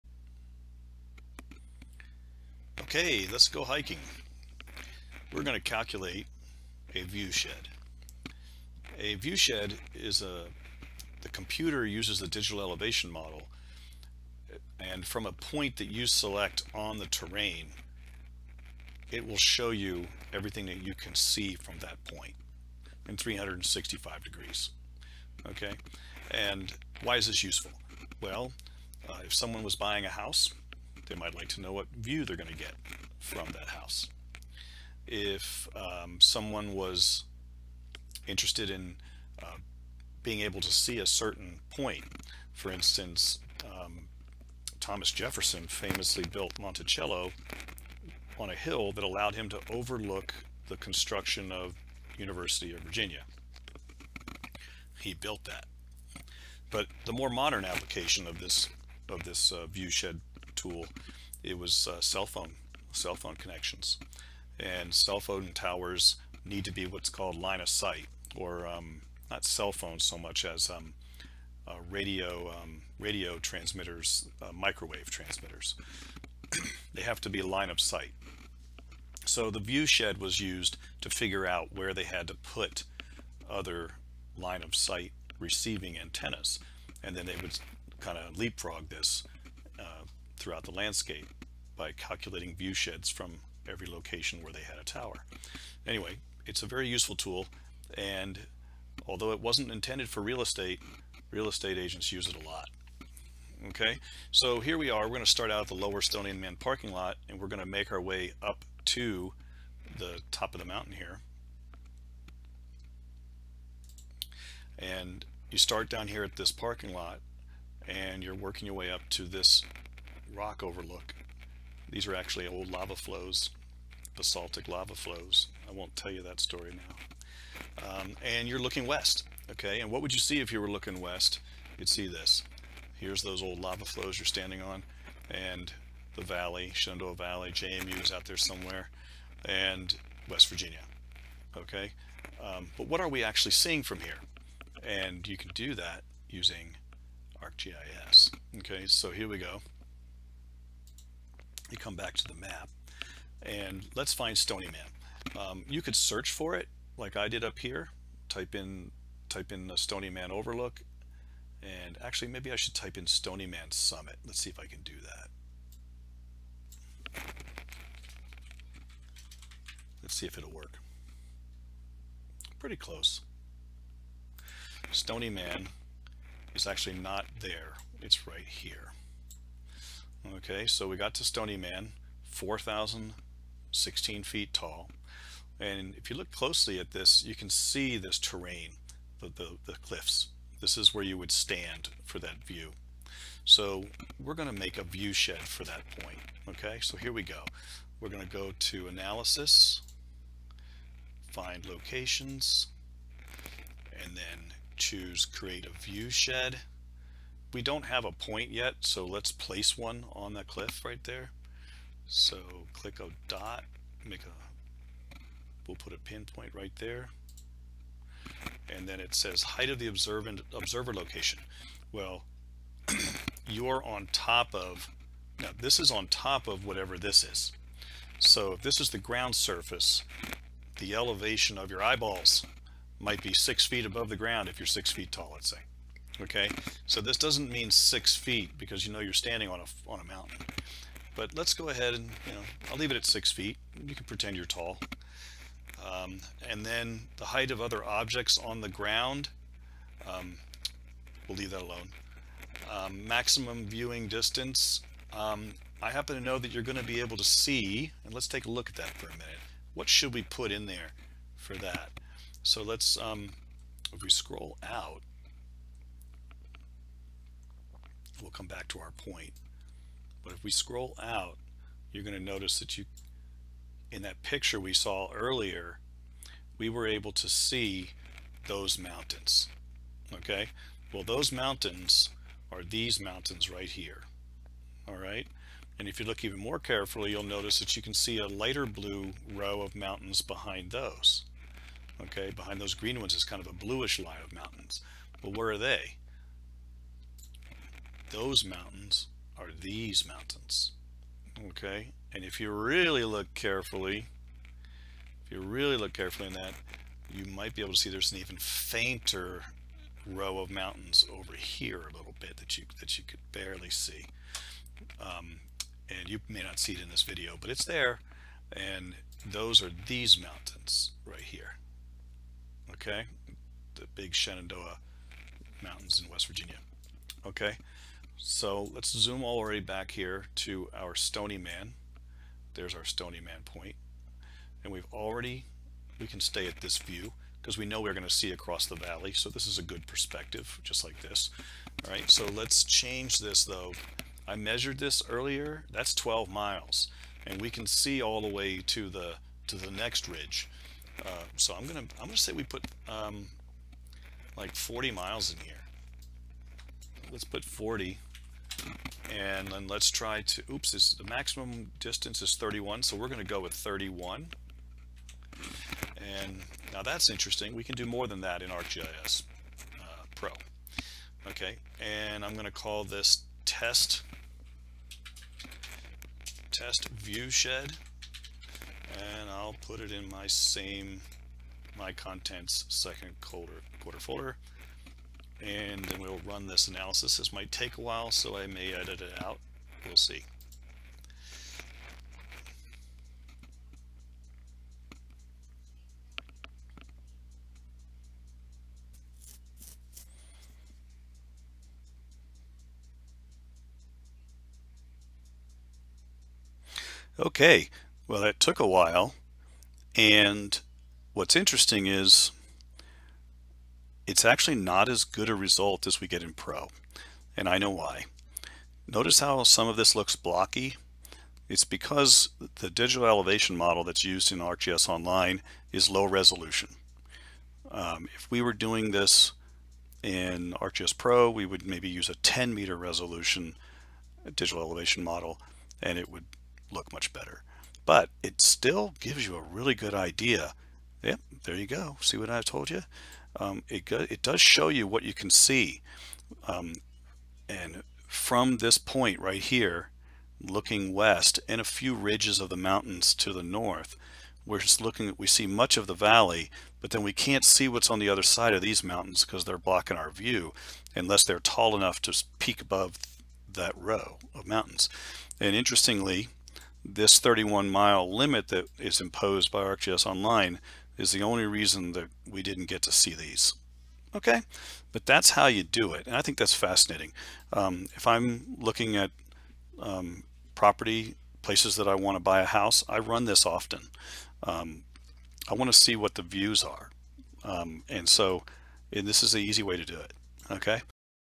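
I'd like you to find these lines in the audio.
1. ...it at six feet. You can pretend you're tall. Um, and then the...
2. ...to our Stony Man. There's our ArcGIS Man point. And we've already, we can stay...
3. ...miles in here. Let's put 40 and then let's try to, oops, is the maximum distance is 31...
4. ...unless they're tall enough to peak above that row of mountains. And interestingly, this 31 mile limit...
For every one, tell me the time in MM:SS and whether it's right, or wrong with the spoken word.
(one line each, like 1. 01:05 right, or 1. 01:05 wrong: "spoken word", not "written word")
1. 04:02 right
2. 05:30 wrong: "Stony", not "ArcGIS"
3. 05:54 right
4. 07:40 right.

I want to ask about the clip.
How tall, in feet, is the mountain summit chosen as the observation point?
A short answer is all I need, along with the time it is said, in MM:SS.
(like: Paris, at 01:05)
4,016 feet, at 03:02.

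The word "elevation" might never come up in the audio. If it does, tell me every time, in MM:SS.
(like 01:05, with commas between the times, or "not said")
00:12, 03:50, 07:03, 07:14.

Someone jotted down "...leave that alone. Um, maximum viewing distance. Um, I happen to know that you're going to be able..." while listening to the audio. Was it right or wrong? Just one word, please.
right.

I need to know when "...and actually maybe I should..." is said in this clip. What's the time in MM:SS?
02:41.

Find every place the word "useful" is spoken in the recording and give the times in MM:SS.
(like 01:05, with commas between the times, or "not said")
00:27, 01:36.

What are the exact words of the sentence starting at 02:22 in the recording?
Um, but what are we actually seeing from here?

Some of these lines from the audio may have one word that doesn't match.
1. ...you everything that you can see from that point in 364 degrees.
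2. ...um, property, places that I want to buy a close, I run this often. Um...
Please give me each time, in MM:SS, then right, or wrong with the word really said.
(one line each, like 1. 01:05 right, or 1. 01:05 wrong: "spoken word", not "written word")
1. 00:19 wrong: "365", not "364"
2. 07:59 wrong: "house", not "close".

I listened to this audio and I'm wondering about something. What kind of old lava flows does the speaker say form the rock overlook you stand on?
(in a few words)
basaltic.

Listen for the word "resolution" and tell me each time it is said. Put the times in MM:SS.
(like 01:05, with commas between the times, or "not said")
07:06, 07:12.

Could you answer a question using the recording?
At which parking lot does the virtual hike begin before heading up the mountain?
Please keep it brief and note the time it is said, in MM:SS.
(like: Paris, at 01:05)
lower Stony Man parking lot, at 01:45.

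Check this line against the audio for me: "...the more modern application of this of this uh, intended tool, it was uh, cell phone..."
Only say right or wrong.
wrong.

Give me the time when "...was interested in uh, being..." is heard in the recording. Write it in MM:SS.
00:36.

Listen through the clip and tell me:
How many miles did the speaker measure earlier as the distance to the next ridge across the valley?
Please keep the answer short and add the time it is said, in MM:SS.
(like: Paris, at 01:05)
12 miles, at 05:45.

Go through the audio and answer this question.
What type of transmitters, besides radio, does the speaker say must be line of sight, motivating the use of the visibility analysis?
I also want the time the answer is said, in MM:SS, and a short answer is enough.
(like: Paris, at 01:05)
microwave, at 01:14.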